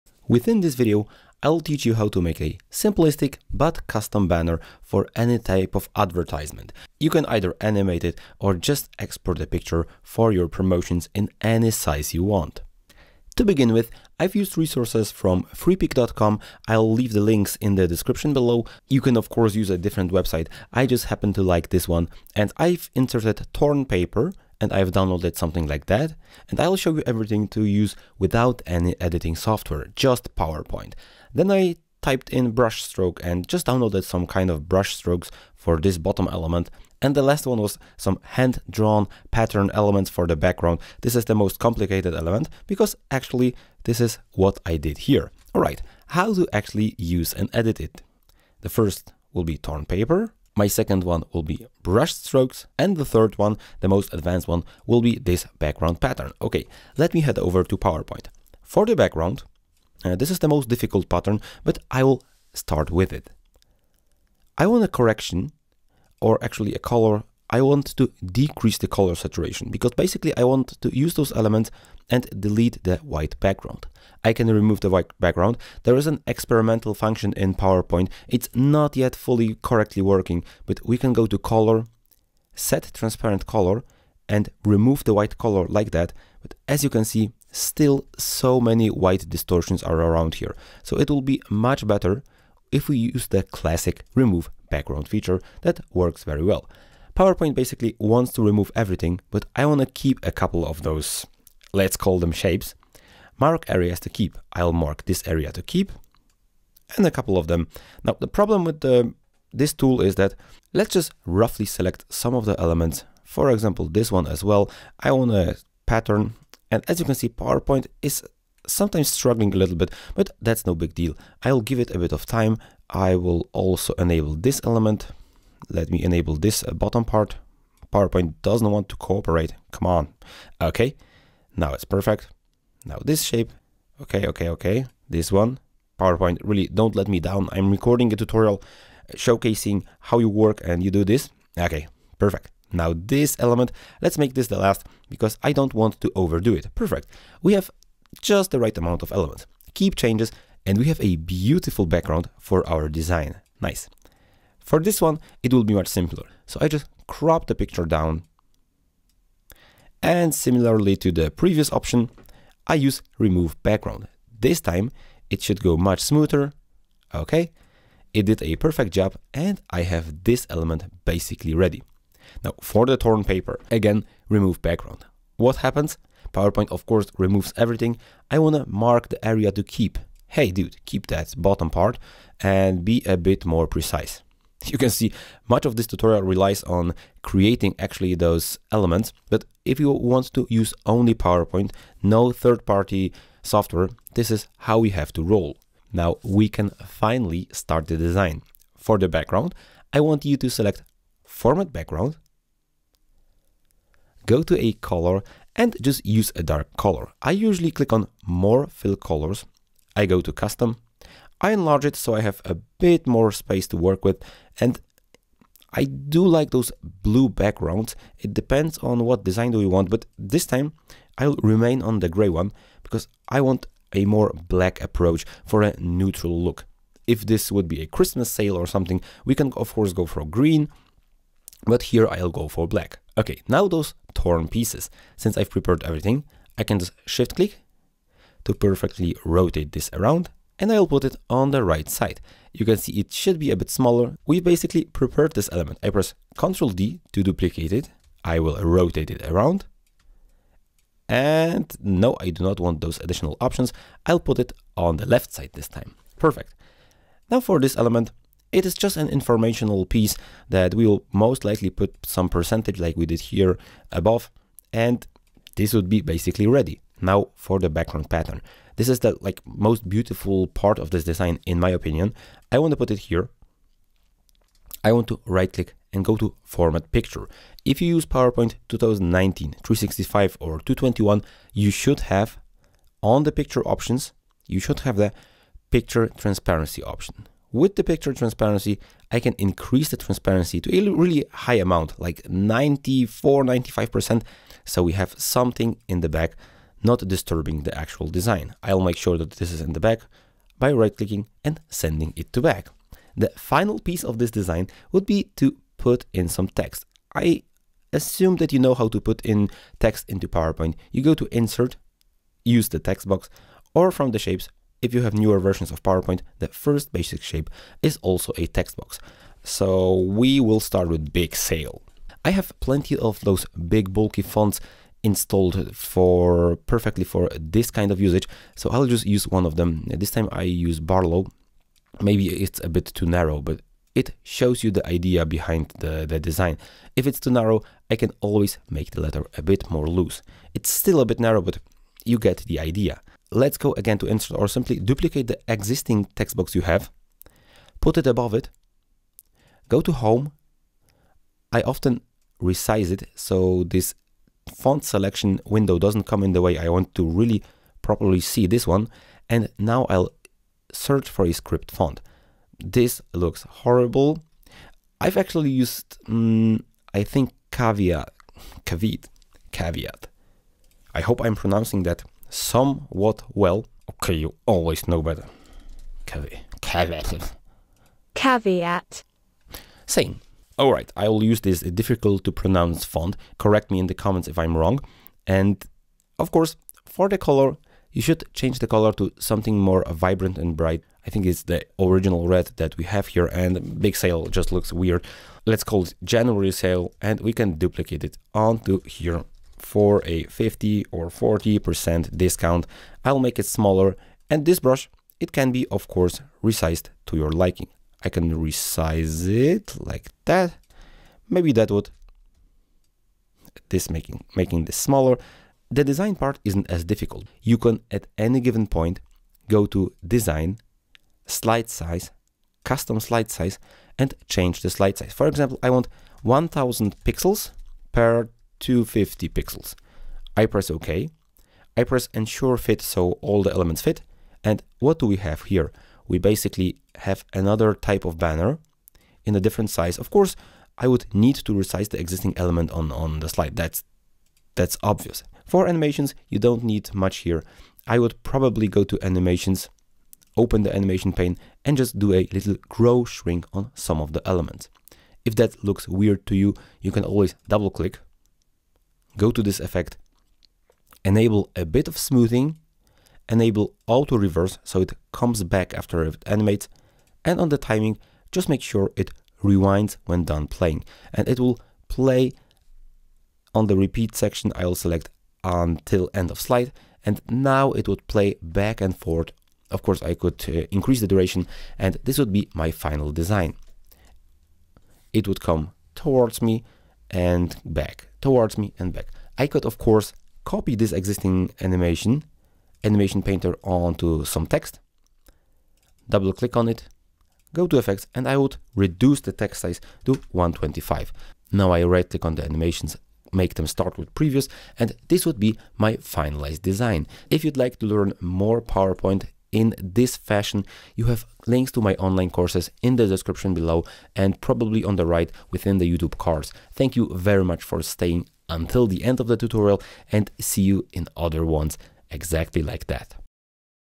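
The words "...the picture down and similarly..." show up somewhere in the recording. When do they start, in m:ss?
2:37.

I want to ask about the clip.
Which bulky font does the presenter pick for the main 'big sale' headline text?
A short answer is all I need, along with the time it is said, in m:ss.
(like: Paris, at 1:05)
Barlow, at 5:30.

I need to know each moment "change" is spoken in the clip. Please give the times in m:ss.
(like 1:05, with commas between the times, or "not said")
2:29, 6:28, 7:04.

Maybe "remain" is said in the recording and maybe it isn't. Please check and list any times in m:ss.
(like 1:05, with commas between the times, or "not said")
3:41.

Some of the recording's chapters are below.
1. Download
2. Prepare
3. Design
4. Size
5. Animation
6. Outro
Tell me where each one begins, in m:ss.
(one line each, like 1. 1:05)
1. 0:13
2. 0:58
3. 3:15
4. 6:57
5. 7:25
6. 8:26.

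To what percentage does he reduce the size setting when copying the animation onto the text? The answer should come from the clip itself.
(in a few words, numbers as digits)
125.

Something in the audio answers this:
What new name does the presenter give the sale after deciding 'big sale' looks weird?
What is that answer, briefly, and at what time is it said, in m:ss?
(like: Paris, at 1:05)
January sale, at 6:36.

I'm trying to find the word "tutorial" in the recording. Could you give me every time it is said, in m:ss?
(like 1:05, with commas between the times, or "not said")
2:18, 3:05, 8:39.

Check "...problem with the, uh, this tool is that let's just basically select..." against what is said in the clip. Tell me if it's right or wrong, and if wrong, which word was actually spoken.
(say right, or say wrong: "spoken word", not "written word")
wrong: "roughly", not "basically".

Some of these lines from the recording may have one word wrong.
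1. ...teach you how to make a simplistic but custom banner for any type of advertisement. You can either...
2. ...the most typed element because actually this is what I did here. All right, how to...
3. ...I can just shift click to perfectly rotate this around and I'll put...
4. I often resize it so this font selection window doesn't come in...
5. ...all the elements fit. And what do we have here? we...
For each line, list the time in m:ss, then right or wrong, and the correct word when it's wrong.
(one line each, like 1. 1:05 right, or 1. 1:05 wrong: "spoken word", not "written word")
1. 0:01 right
2. 0:41 wrong: "complicated", not "typed"
3. 3:56 right
4. 5:51 right
5. 7:13 right.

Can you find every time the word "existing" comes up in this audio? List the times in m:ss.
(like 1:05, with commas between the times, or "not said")
5:45, 7:22, 8:10.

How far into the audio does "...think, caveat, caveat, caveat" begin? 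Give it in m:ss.
6:07.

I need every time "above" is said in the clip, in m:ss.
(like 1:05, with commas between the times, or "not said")
4:23, 5:48.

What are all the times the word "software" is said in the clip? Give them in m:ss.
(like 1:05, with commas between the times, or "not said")
0:29, 3:13.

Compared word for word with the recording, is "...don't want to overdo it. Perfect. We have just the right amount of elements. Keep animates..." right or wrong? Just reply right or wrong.
wrong.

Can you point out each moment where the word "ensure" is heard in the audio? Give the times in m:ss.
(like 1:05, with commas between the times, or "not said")
7:12.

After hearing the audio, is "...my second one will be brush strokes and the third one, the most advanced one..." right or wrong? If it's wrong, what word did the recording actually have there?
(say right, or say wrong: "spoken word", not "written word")
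right.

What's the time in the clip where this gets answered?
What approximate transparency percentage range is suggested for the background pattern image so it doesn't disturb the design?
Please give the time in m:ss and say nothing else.
4:52.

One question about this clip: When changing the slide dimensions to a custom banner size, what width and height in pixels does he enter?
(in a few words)
1000 by 250 pixels.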